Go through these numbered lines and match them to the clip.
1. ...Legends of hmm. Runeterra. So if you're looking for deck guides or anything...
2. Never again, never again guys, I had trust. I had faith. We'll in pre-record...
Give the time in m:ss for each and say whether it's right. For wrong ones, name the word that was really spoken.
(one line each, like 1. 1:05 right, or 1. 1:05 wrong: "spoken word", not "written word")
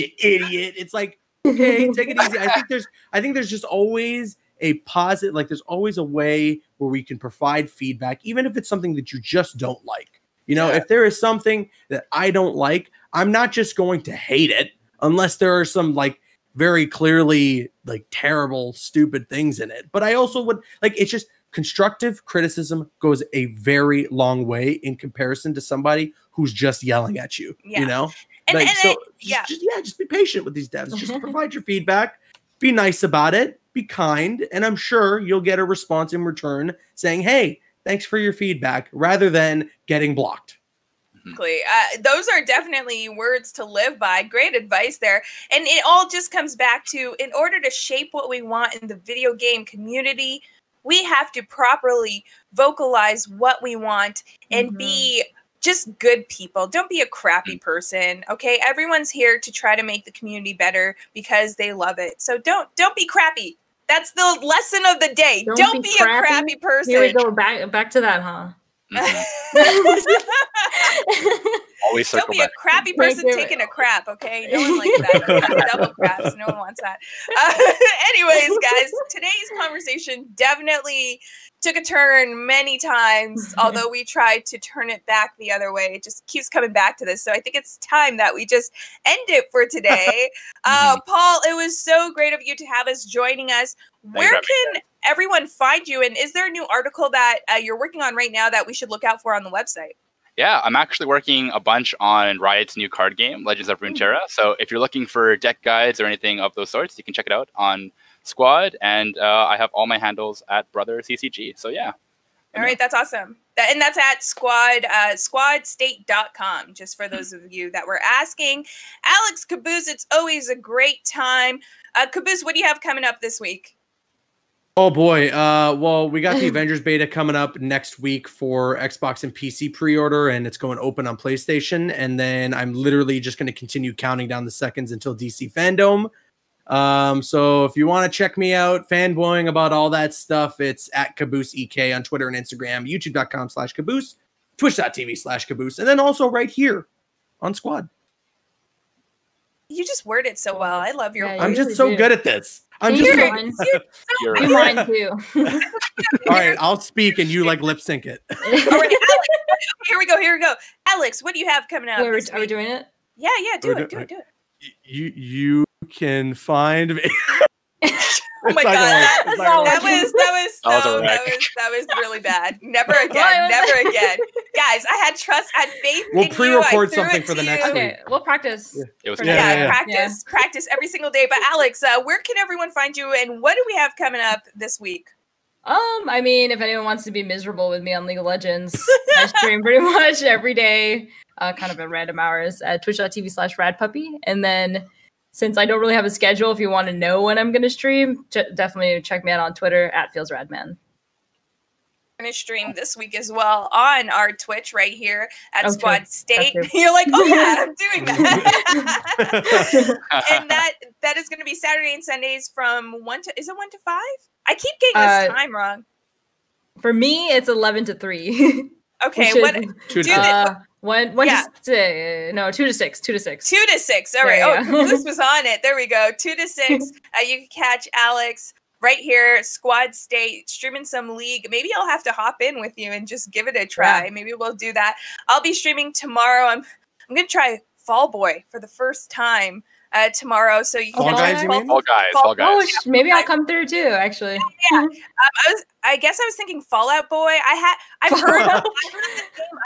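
1. 1:43 right
2. 2:52 right.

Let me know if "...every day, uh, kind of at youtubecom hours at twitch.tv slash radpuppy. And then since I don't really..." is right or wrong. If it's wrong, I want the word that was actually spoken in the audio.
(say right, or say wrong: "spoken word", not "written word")
wrong: "random", not "youtubecom".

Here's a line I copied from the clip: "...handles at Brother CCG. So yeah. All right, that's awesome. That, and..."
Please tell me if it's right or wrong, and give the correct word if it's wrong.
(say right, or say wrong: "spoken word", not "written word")
right.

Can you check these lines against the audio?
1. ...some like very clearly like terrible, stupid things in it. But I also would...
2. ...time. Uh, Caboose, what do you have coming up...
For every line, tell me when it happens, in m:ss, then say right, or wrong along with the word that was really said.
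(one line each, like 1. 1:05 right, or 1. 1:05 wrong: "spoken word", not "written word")
1. 0:15 right
2. 2:01 right.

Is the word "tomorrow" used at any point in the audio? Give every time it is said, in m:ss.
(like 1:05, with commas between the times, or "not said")
3:55, 4:00.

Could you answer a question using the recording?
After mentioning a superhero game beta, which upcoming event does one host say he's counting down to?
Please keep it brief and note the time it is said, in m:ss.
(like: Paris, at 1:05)
DC Fandom, at 2:15.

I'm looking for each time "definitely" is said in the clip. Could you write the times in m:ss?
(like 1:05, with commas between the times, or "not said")
0:42, 1:20, 3:18.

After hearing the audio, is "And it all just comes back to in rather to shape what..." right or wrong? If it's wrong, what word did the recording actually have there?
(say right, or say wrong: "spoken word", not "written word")
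wrong: "order", not "rather".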